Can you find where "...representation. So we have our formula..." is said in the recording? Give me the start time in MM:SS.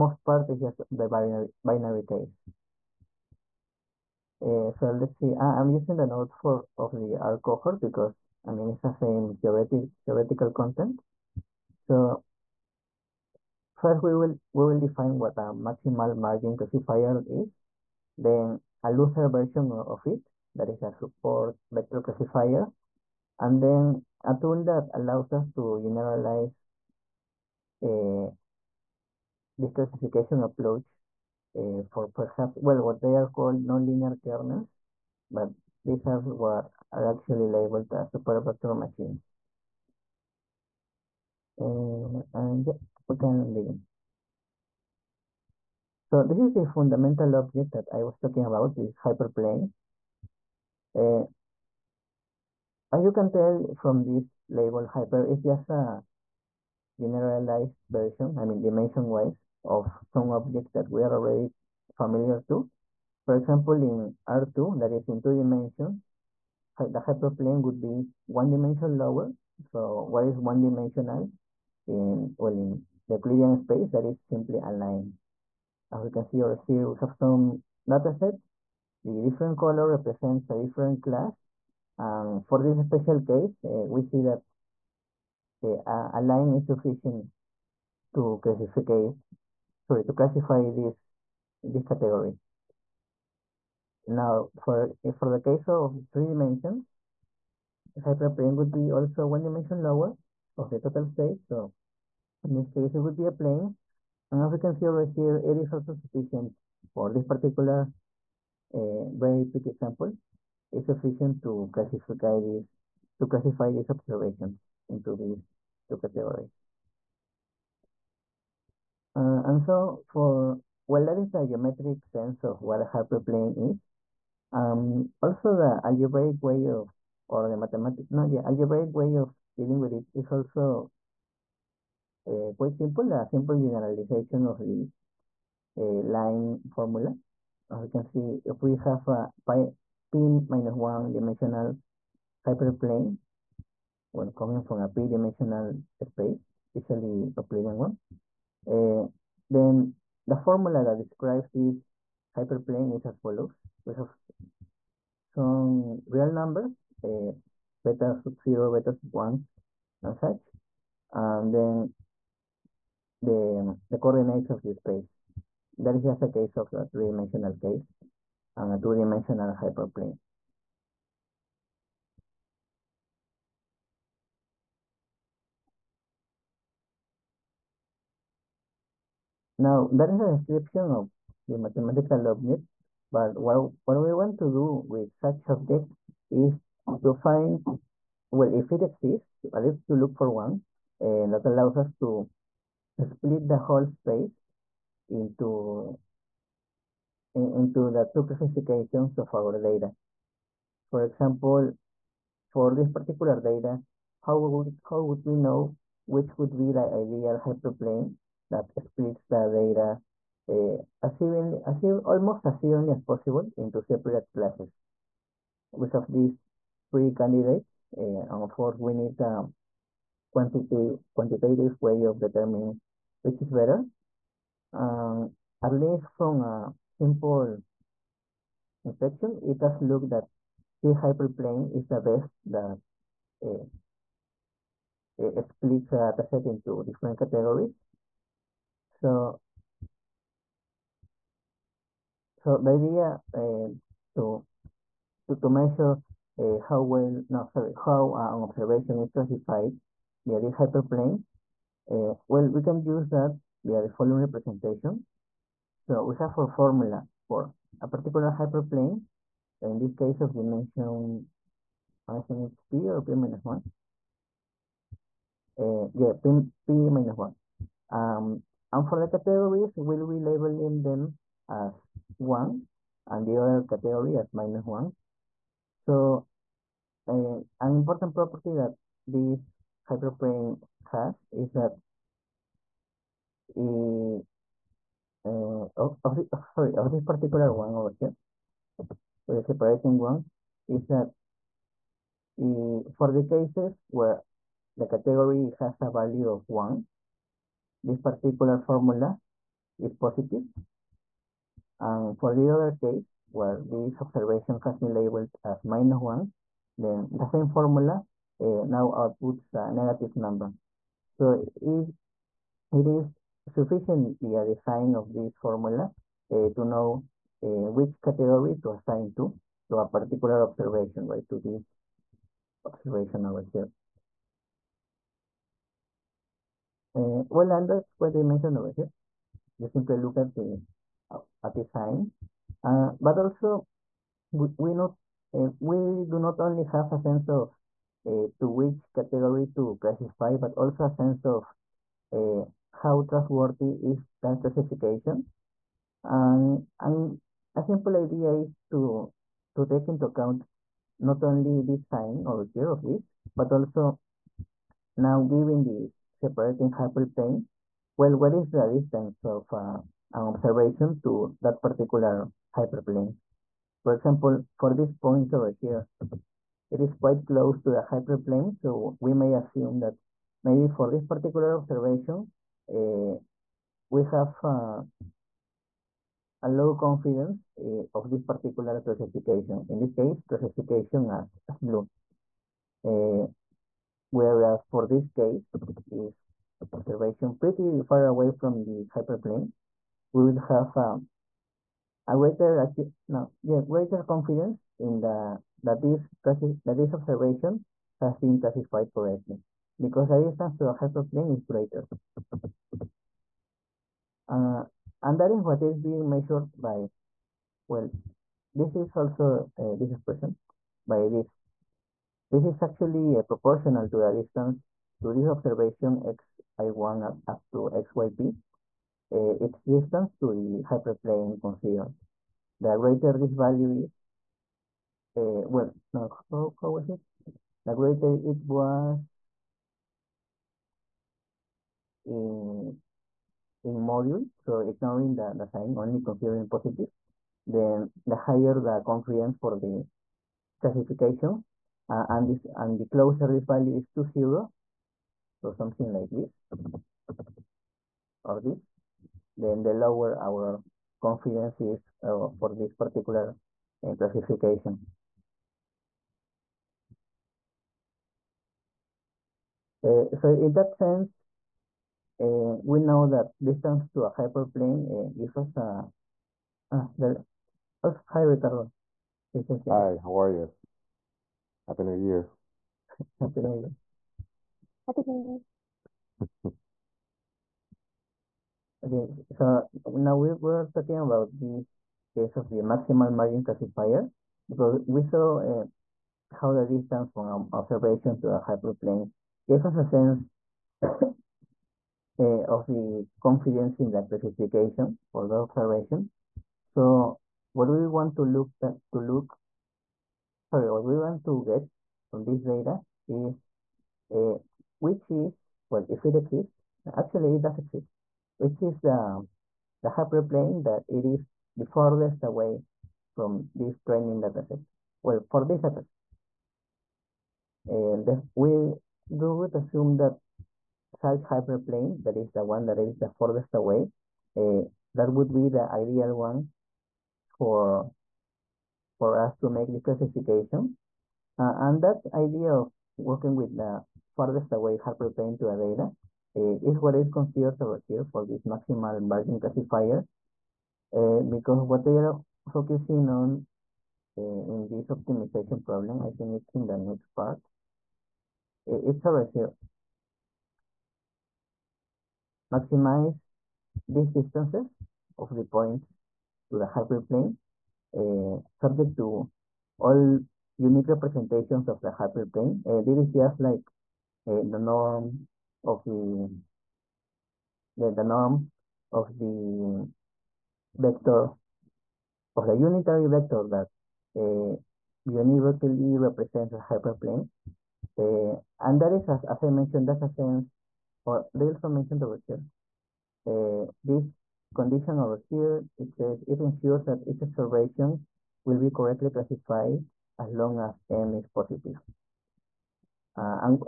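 04:14.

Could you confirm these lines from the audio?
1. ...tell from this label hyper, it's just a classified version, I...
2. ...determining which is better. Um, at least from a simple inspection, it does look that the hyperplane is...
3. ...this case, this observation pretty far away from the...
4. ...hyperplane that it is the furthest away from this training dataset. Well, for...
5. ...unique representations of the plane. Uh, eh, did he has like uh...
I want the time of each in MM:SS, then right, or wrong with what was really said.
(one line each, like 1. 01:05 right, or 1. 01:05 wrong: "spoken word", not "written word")
1. 00:53 wrong: "generalized", not "classified"
2. 03:42 right
3. 06:24 right
4. 08:29 right
5. 09:20 wrong: "hyperplane", not "plane".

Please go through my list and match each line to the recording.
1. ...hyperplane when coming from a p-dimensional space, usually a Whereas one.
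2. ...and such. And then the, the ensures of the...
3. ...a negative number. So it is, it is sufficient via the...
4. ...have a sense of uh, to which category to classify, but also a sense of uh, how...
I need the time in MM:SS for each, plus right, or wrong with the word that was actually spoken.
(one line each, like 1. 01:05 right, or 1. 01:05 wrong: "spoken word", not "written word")
1. 02:22 wrong: "Euclidean", not "Whereas"
2. 02:40 wrong: "coordinates", not "ensures"
3. 05:09 right
4. 05:36 right.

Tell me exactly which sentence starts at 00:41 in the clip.
Eh, and yeah, we can begin.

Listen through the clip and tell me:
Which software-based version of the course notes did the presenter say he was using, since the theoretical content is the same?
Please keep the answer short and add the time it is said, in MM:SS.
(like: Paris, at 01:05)
R cohort, at 00:07.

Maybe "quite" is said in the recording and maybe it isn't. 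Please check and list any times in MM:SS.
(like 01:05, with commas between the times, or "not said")
02:12, 06:06.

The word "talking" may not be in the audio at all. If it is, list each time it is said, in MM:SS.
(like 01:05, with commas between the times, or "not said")
00:48, 08:00.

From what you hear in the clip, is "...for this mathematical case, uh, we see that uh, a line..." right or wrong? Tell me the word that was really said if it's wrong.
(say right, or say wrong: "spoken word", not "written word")
wrong: "special", not "mathematical".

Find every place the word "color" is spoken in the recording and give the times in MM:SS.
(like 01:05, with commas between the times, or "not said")
01:19.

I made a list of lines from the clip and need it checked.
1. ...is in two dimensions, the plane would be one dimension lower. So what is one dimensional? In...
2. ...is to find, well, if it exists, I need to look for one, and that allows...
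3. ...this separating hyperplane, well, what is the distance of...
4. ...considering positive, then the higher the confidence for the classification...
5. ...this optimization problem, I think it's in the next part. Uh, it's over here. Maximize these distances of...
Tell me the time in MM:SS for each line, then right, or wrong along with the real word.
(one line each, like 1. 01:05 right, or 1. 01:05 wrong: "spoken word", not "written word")
1. 01:04 wrong: "hyperplane", not "plane"
2. 03:06 right
3. 05:55 right
4. 07:16 right
5. 09:04 right.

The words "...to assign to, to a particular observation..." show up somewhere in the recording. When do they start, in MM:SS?
05:18.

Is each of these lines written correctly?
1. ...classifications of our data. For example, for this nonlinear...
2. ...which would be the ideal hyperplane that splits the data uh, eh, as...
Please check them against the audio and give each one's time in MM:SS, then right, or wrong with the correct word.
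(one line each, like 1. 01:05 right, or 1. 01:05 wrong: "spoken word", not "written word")
1. 03:18 wrong: "particular", not "nonlinear"
2. 03:26 right.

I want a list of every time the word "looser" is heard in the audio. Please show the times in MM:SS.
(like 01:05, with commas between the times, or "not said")
00:18.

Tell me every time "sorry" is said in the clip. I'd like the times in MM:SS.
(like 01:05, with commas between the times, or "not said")
01:29, 04:07, 04:46, 08:20.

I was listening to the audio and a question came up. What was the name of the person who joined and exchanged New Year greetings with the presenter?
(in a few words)
Ricardo.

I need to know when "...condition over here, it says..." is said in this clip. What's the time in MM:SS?
09:44.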